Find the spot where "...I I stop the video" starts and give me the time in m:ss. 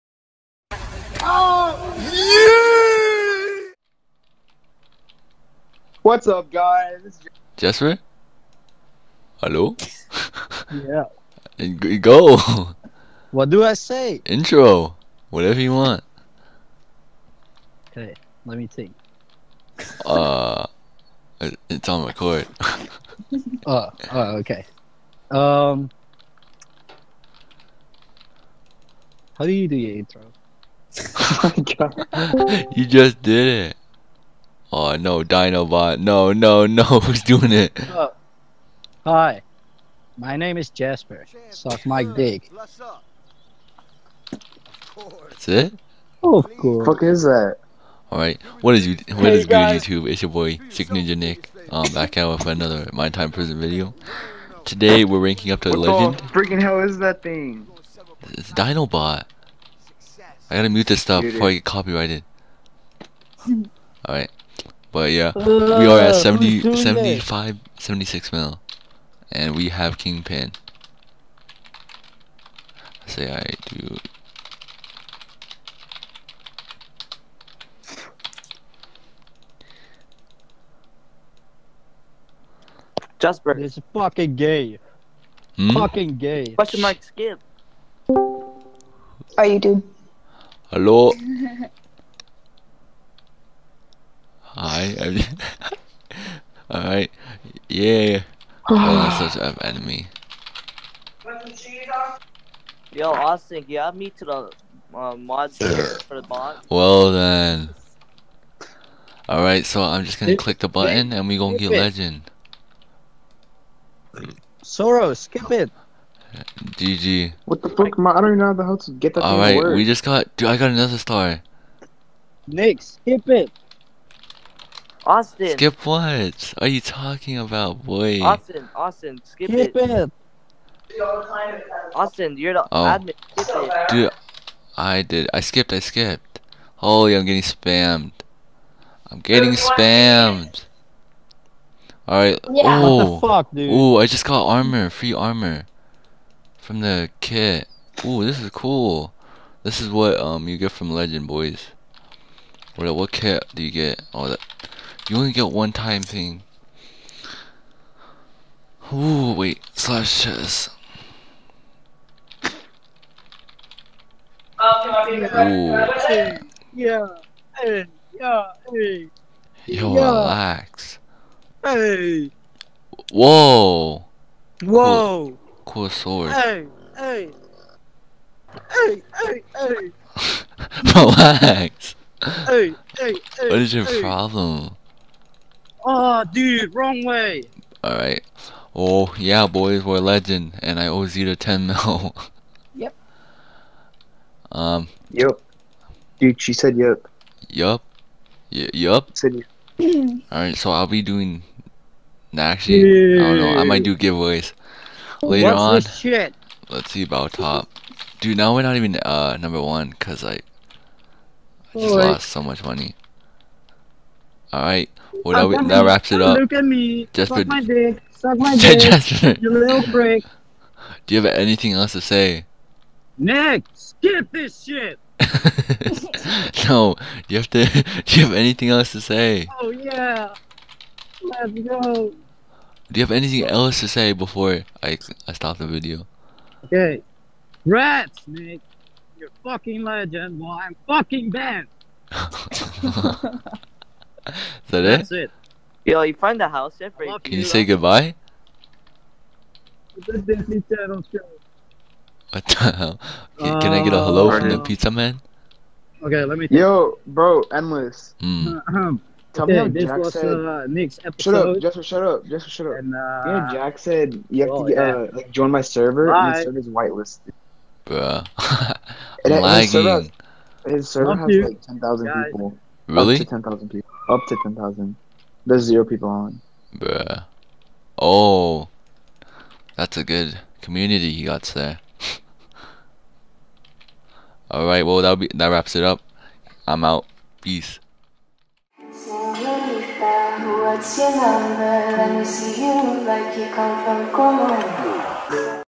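3:54.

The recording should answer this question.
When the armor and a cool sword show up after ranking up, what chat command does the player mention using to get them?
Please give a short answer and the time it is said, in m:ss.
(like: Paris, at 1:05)
/chest, at 2:39.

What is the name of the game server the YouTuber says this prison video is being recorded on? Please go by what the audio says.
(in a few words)
Minetime.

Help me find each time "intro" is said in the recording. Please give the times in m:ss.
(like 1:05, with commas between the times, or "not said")
0:14, 0:29.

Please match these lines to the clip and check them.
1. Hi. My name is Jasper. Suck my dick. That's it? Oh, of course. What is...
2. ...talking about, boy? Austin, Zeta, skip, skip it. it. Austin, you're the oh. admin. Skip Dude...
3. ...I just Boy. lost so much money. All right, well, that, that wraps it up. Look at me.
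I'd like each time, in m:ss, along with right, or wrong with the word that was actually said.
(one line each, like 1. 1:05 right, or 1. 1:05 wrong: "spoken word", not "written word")
1. 0:39 right
2. 2:06 wrong: "Austin", not "Zeta"
3. 3:30 right.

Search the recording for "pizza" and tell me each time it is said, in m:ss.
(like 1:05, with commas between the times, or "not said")
4:14.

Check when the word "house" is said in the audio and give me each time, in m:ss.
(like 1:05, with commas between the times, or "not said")
4:06.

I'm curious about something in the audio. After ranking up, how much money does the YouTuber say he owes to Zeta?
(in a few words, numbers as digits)
10 mil.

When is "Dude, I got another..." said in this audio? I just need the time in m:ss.
2:00.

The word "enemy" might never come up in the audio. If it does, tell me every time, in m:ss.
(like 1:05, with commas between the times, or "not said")
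1:39.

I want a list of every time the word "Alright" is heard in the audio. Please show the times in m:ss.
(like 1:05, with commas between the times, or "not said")
0:48, 1:04, 1:36, 1:49, 3:07, 3:20, 4:44.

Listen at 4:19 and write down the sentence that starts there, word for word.
Tell okay, me how this Jack was said, uh, Nick's episode.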